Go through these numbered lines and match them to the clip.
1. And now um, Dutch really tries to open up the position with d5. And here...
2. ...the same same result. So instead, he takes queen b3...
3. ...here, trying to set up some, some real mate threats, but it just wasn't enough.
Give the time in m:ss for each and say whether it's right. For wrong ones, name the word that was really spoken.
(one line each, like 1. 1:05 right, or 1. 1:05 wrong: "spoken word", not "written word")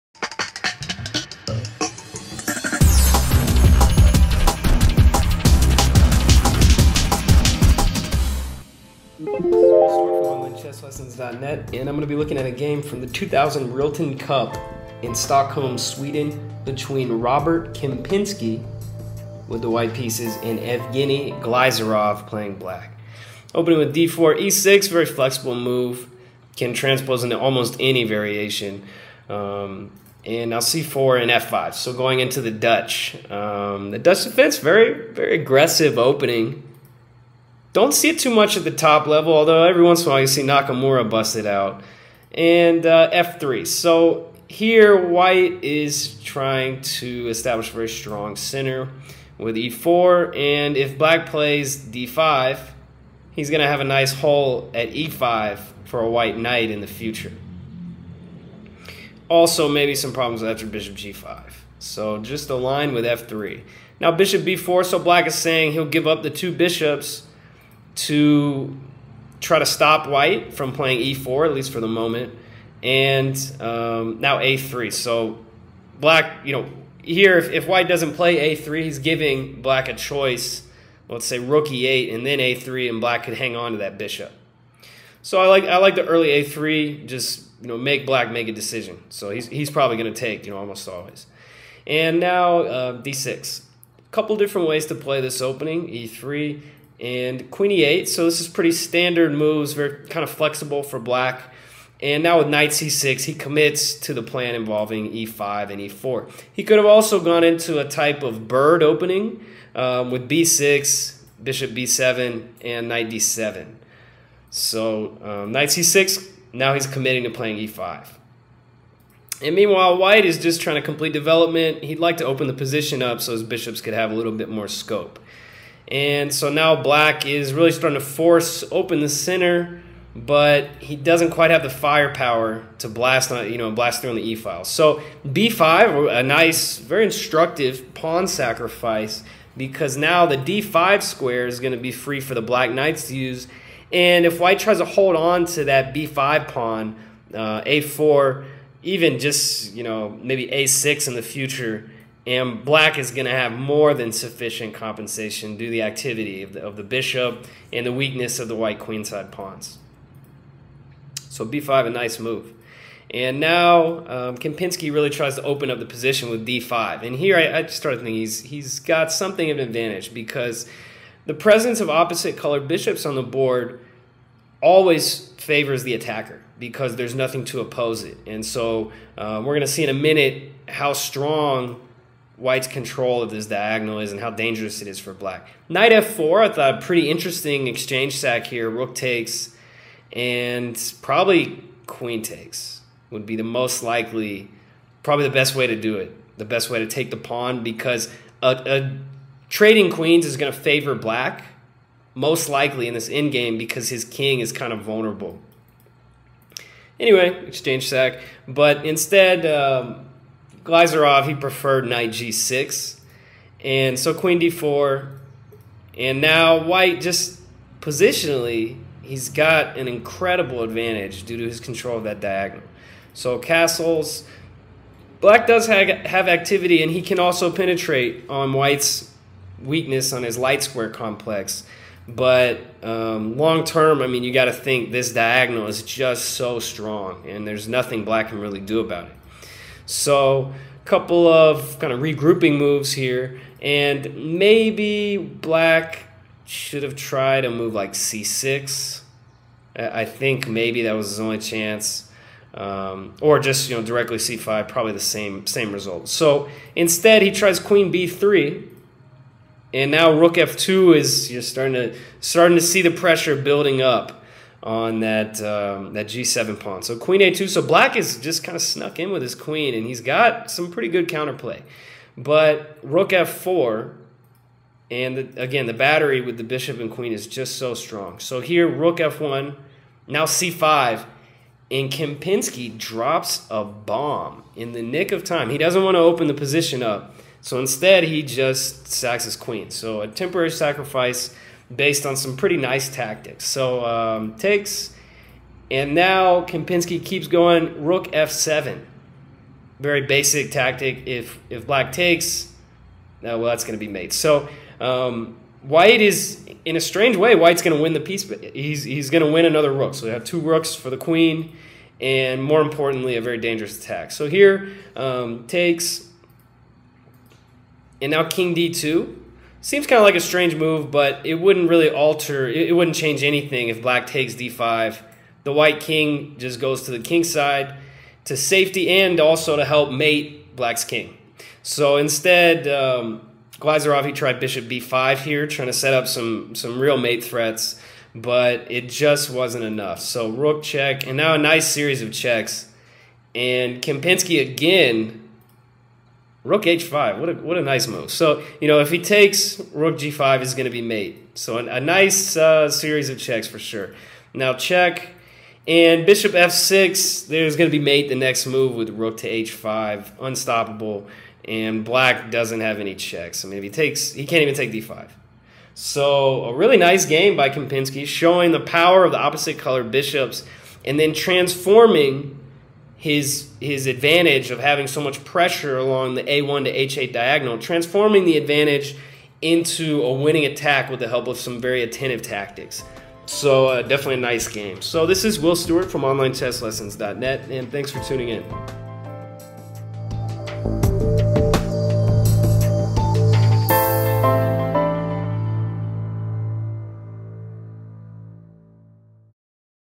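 1. 2:43 wrong: "Kempinski", not "Dutch"
2. 4:14 wrong: "tries", not "takes"
3. 5:35 right.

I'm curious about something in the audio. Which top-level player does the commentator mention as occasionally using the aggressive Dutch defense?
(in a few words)
Nakamura.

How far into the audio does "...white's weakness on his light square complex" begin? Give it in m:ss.
3:48.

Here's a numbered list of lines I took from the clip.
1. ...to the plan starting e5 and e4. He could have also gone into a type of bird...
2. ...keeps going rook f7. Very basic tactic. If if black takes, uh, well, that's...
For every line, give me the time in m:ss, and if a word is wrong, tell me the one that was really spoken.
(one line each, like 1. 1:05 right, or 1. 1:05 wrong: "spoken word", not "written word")
1. 1:44 wrong: "involving", not "starting"
2. 4:57 right.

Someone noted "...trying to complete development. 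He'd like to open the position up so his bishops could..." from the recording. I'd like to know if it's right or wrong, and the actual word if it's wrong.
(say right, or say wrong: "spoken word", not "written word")
right.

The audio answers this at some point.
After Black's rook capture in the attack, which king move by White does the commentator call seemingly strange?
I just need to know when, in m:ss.
5:18.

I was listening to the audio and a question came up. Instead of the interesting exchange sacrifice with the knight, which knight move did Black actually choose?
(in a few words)
knight g6.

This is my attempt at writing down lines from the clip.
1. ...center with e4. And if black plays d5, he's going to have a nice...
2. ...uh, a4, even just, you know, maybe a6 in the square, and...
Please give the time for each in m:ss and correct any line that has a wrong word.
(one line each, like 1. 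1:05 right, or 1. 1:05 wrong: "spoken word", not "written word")
1. 0:48 right
2. 2:27 wrong: "future", not "square".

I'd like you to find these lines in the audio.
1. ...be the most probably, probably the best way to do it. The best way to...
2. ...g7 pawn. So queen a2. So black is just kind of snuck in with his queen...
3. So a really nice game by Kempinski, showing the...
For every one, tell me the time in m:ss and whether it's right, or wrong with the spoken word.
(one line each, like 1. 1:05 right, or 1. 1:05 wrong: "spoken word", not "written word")
1. 3:13 wrong: "likely", not "probably"
2. 4:26 right
3. 6:05 right.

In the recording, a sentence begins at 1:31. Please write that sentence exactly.
And now uh, d6, a couple different ways to play this opening e3 and queen e8.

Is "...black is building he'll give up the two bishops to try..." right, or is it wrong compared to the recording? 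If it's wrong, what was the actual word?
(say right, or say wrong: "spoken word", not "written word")
wrong: "saying", not "building".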